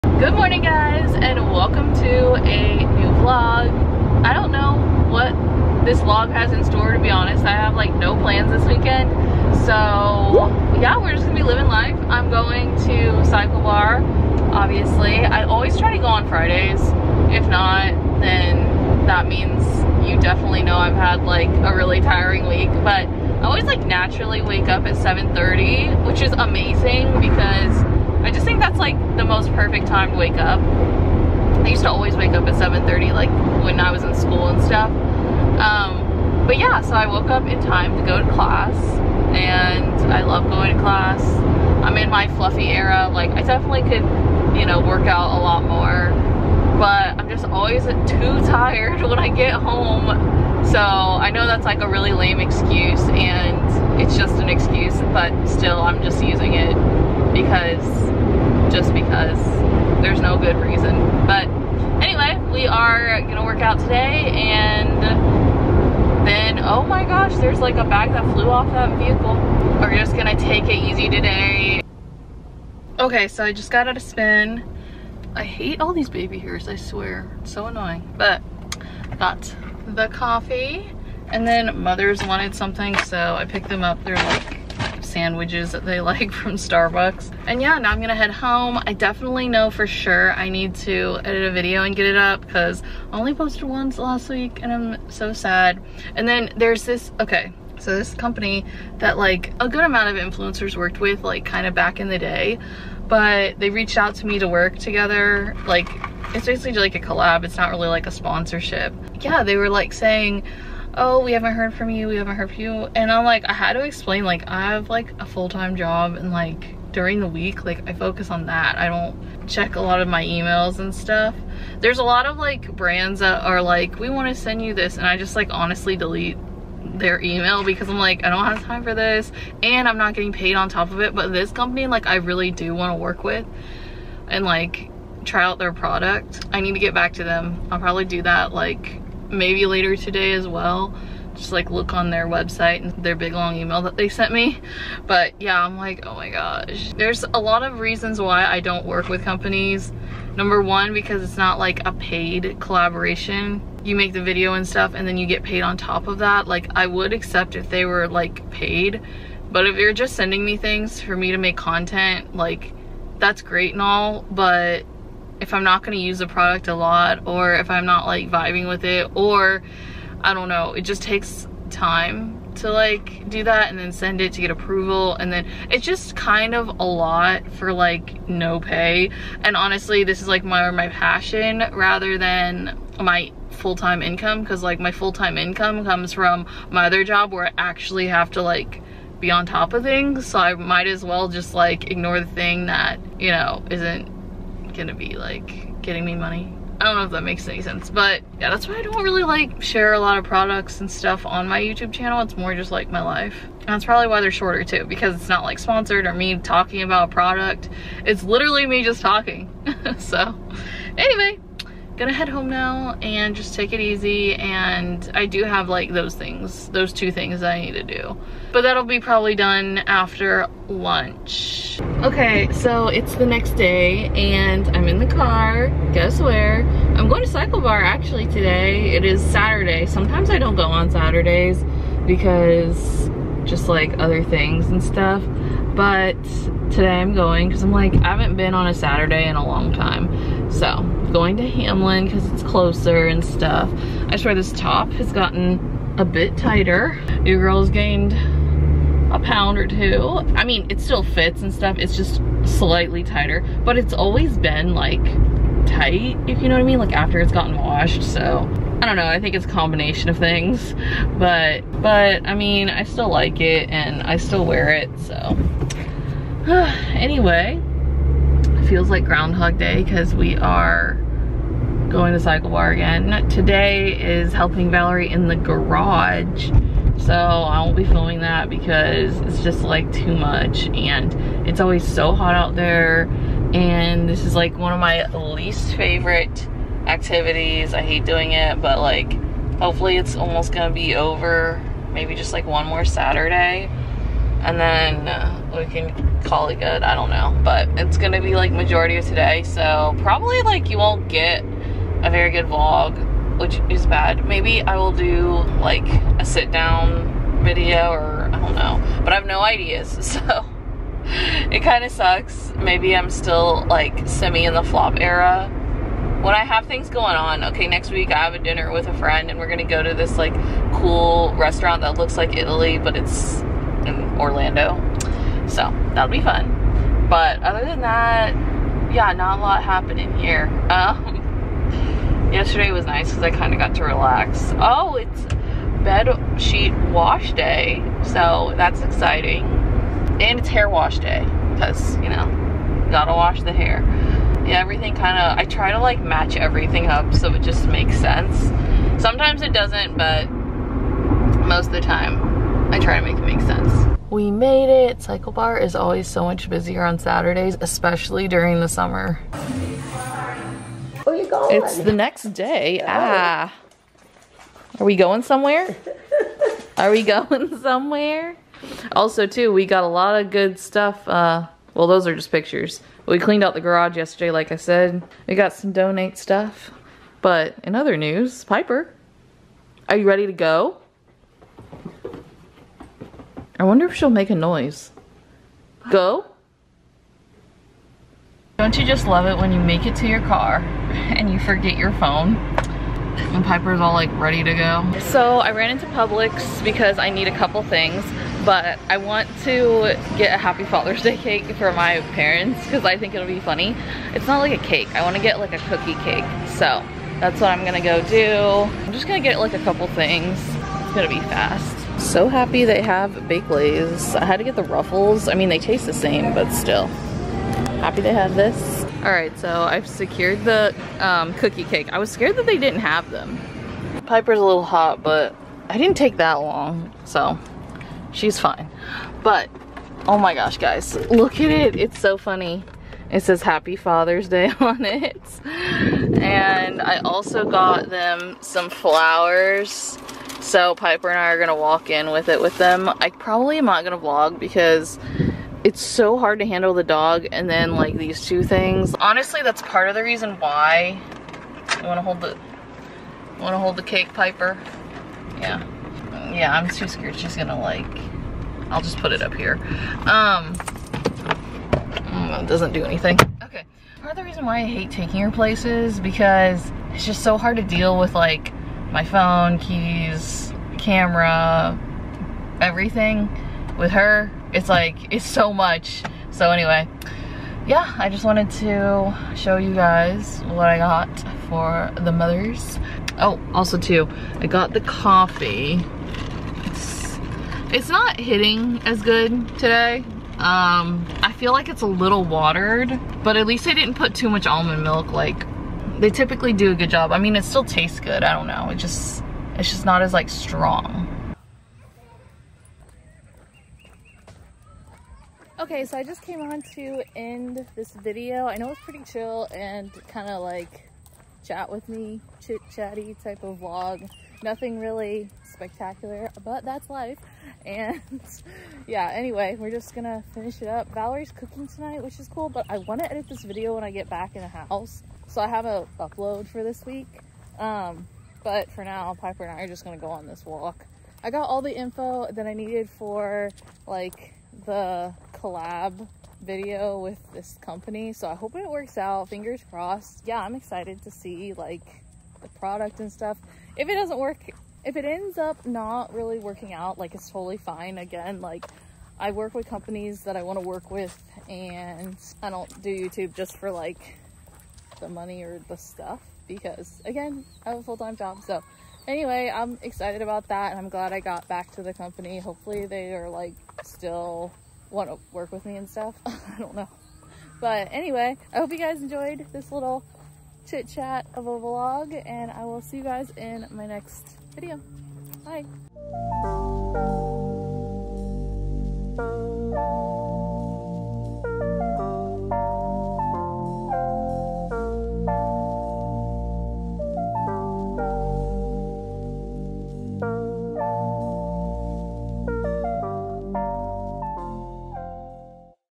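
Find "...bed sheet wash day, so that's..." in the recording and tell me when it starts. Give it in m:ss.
5:35.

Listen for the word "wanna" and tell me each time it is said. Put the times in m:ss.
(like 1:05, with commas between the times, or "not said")
8:42.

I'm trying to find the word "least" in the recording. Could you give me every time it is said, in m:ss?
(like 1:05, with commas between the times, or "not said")
4:45, 8:13.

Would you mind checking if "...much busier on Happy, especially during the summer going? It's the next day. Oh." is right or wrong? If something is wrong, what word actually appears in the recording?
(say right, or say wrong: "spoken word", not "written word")
wrong: "Saturdays", not "Happy".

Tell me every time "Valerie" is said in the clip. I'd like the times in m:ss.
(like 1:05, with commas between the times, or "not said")
4:34, 8:40.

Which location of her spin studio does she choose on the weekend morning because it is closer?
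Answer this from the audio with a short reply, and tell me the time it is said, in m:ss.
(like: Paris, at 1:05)
Hamlin, at 4:01.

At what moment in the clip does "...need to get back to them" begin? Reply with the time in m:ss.
2:16.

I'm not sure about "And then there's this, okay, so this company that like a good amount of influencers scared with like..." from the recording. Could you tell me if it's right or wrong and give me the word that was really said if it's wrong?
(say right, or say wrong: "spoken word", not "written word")
wrong: "worked", not "scared".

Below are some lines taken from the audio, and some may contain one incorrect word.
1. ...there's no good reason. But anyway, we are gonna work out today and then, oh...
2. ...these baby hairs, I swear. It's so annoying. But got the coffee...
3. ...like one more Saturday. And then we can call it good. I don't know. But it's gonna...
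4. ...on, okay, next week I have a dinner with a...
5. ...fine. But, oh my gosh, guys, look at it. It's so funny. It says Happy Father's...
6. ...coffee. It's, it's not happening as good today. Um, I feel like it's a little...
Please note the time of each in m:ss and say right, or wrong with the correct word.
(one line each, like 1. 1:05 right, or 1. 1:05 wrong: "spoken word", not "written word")
1. 1:00 right
2. 1:15 right
3. 4:52 right
4. 5:17 right
5. 7:08 right
6. 8:04 wrong: "hitting", not "happening".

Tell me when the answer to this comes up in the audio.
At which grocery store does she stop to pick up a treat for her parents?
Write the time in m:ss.
6:35.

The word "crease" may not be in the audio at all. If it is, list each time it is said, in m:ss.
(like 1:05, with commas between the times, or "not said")
not said.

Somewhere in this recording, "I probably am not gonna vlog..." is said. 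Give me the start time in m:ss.
7:22.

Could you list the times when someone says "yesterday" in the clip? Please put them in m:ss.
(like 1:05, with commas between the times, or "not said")
5:32, 6:13.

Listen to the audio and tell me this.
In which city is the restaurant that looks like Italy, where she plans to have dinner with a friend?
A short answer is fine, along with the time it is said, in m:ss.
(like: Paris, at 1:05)
Orlando, at 5:24.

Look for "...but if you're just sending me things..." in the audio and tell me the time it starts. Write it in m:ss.
2:39.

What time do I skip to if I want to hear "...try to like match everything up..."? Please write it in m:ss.
5:45.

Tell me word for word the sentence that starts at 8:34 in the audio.
Nothing really spectacular, but that's life.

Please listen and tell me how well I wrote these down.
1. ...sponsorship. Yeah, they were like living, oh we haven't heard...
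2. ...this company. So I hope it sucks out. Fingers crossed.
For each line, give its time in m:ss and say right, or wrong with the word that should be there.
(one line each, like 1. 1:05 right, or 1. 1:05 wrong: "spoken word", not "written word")
1. 1:48 wrong: "saying", not "living"
2. 8:57 wrong: "works", not "sucks".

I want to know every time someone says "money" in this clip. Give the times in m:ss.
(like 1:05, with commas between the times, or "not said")
3:16, 9:15.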